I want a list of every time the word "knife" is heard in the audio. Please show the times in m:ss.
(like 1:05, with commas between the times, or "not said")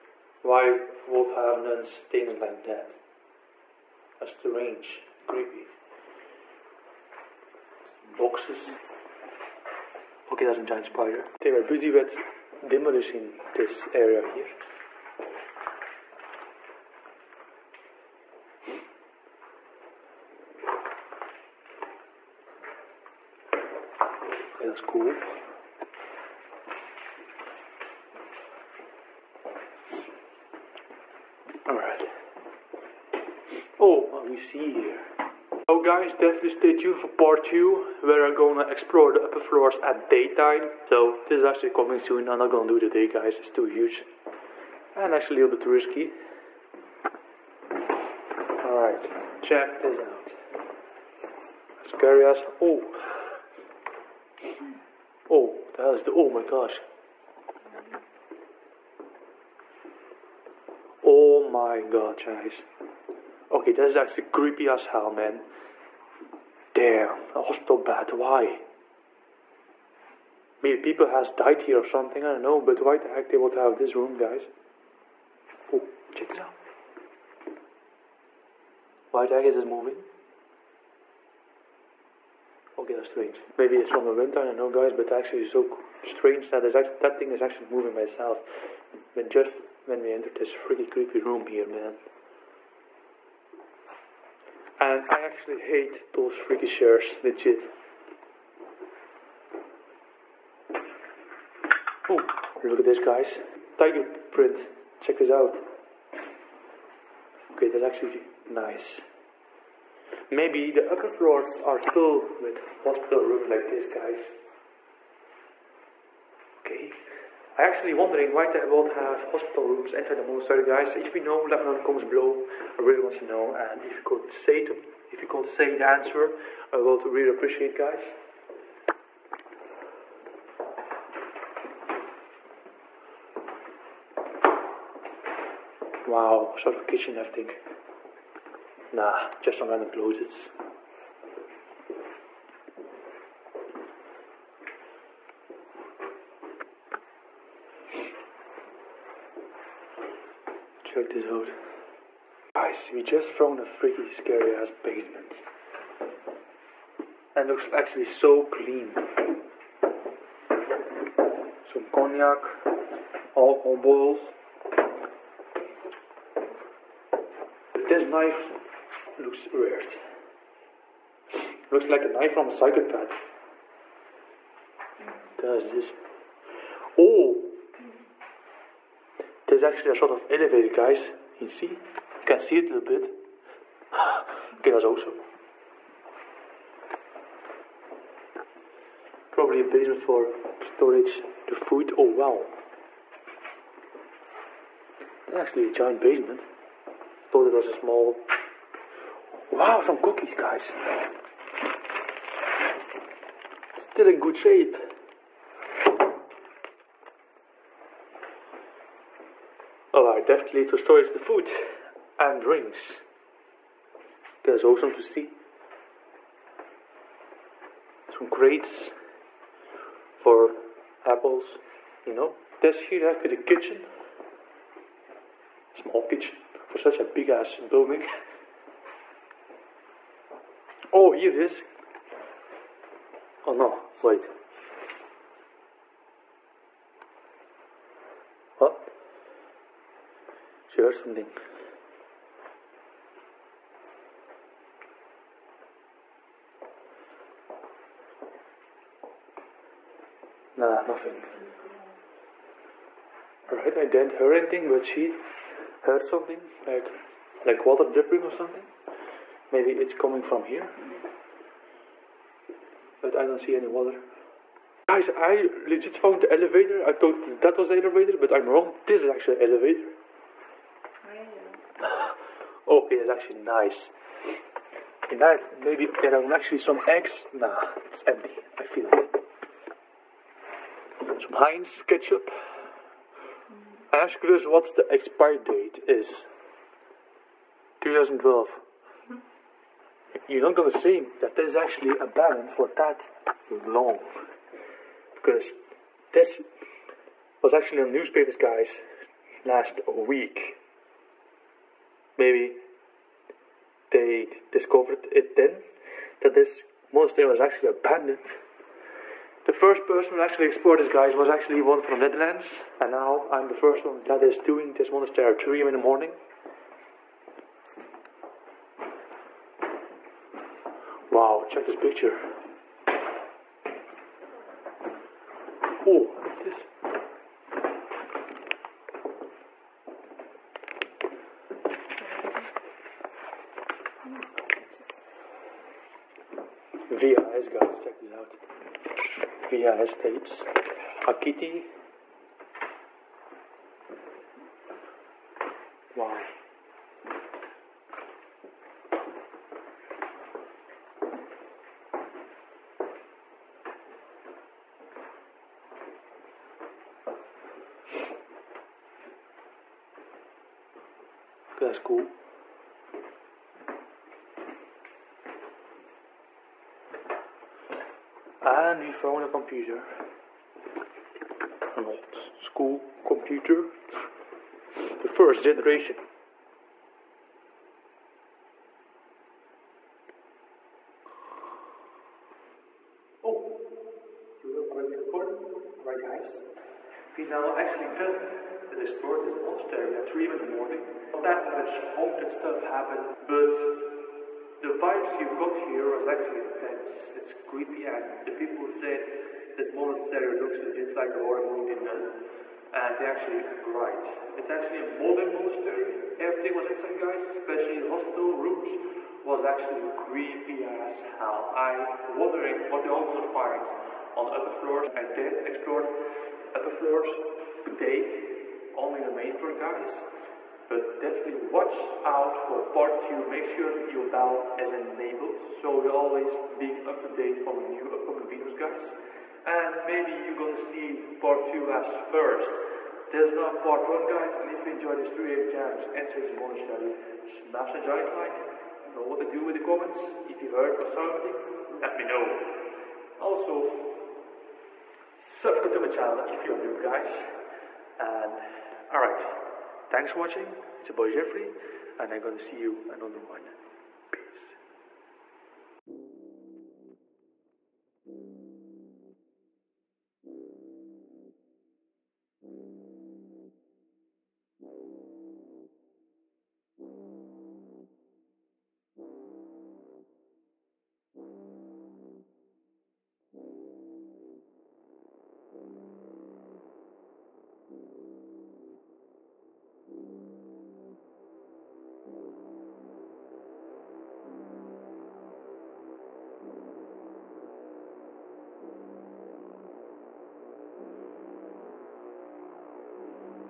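2:48, 2:52.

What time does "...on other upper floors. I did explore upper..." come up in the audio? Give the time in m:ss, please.
6:54.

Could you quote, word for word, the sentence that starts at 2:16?
Wow, sort of a kitchen, I think.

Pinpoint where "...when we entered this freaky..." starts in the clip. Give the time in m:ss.
1:29.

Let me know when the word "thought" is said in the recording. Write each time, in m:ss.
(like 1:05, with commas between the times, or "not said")
3:17, 4:26.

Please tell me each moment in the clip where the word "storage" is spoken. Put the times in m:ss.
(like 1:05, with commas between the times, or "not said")
3:10, 3:30.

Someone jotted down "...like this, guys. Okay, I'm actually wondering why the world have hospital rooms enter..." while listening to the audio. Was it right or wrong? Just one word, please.
right.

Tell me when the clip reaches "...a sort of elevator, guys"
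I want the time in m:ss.
2:59.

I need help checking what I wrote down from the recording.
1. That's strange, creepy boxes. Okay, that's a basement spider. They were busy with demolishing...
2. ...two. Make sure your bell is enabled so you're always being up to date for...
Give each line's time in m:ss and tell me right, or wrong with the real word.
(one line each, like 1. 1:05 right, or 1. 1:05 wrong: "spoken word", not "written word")
1. 0:04 wrong: "giant", not "basement"
2. 7:03 right.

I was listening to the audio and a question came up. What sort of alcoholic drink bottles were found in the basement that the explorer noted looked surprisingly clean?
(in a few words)
Cognac.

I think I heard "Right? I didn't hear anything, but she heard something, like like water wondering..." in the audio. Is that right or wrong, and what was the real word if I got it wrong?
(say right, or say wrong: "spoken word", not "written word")
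wrong: "dripping", not "wondering".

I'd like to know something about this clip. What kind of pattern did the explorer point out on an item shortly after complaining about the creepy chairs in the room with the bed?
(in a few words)
Tiger print.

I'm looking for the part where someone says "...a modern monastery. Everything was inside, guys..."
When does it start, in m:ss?
6:44.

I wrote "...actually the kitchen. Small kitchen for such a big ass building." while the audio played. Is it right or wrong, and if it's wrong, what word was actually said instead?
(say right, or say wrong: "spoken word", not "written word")
right.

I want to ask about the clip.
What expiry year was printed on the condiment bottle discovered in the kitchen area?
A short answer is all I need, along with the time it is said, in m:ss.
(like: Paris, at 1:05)
2012, at 4:47.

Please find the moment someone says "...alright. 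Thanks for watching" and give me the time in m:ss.
7:28.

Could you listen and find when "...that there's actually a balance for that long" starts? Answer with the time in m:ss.
4:51.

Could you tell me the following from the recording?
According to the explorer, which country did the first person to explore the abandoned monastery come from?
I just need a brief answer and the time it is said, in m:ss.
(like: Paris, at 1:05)
The Netherlands, at 5:11.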